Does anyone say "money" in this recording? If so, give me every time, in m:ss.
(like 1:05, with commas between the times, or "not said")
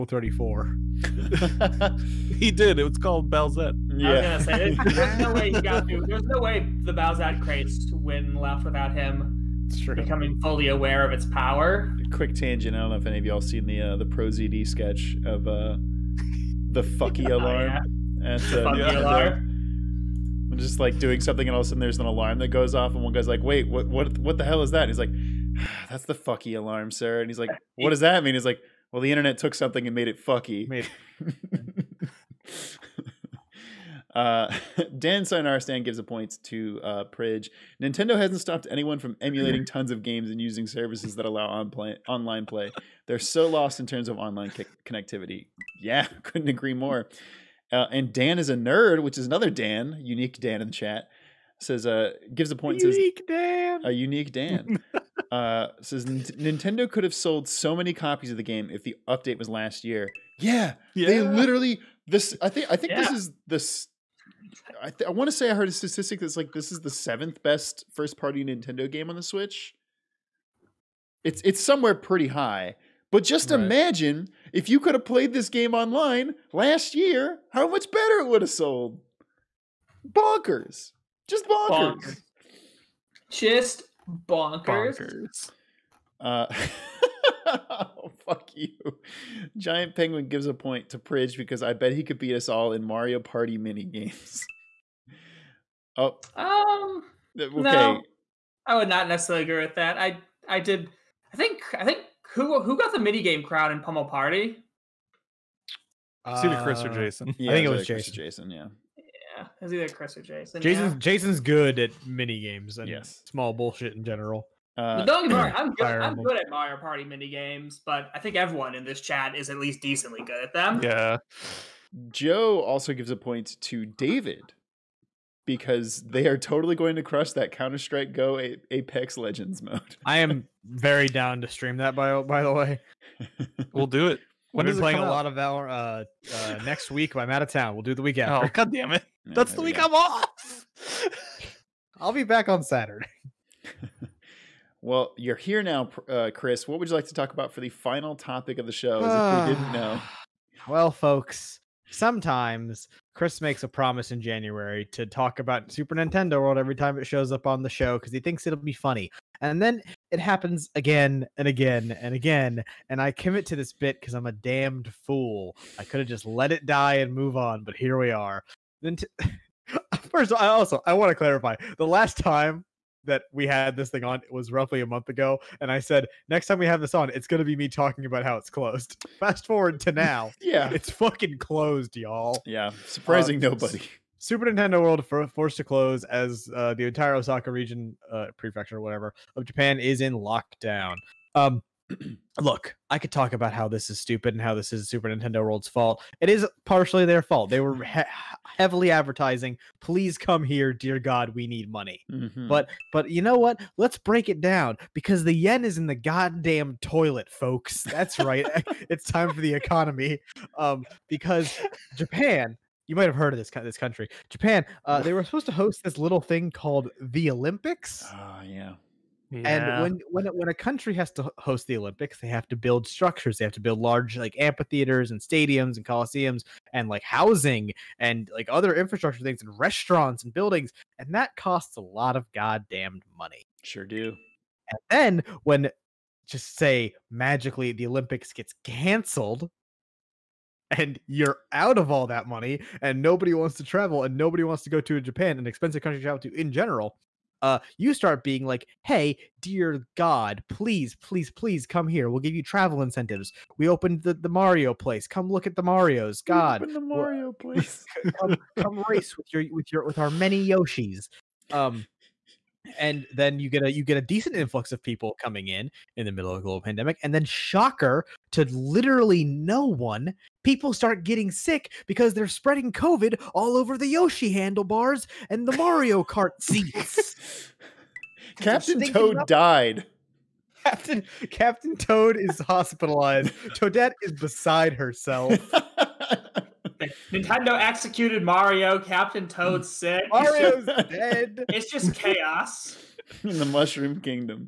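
3:21, 3:53, 4:02.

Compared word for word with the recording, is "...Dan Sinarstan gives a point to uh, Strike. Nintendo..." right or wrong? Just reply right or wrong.
wrong.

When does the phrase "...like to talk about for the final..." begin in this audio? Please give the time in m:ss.
2:26.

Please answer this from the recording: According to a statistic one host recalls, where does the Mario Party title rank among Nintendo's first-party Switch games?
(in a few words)
7th.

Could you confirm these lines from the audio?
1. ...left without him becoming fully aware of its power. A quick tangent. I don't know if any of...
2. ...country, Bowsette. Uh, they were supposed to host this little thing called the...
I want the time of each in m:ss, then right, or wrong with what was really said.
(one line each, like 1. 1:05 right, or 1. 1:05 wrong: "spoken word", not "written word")
1. 0:08 right
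2. 3:33 wrong: "Japan", not "Bowsette".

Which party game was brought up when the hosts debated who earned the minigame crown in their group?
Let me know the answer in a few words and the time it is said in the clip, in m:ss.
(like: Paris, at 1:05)
Pummel Party, at 1:43.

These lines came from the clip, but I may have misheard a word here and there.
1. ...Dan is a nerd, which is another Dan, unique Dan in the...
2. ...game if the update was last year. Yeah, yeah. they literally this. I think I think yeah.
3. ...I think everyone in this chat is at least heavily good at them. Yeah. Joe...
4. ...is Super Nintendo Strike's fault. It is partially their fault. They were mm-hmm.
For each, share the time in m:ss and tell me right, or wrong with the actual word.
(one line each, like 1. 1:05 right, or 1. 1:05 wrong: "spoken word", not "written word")
1. 0:48 right
2. 0:58 right
3. 1:58 wrong: "decently", not "heavily"
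4. 3:14 wrong: "World", not "Strike".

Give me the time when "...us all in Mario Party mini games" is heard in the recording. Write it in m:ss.
1:32.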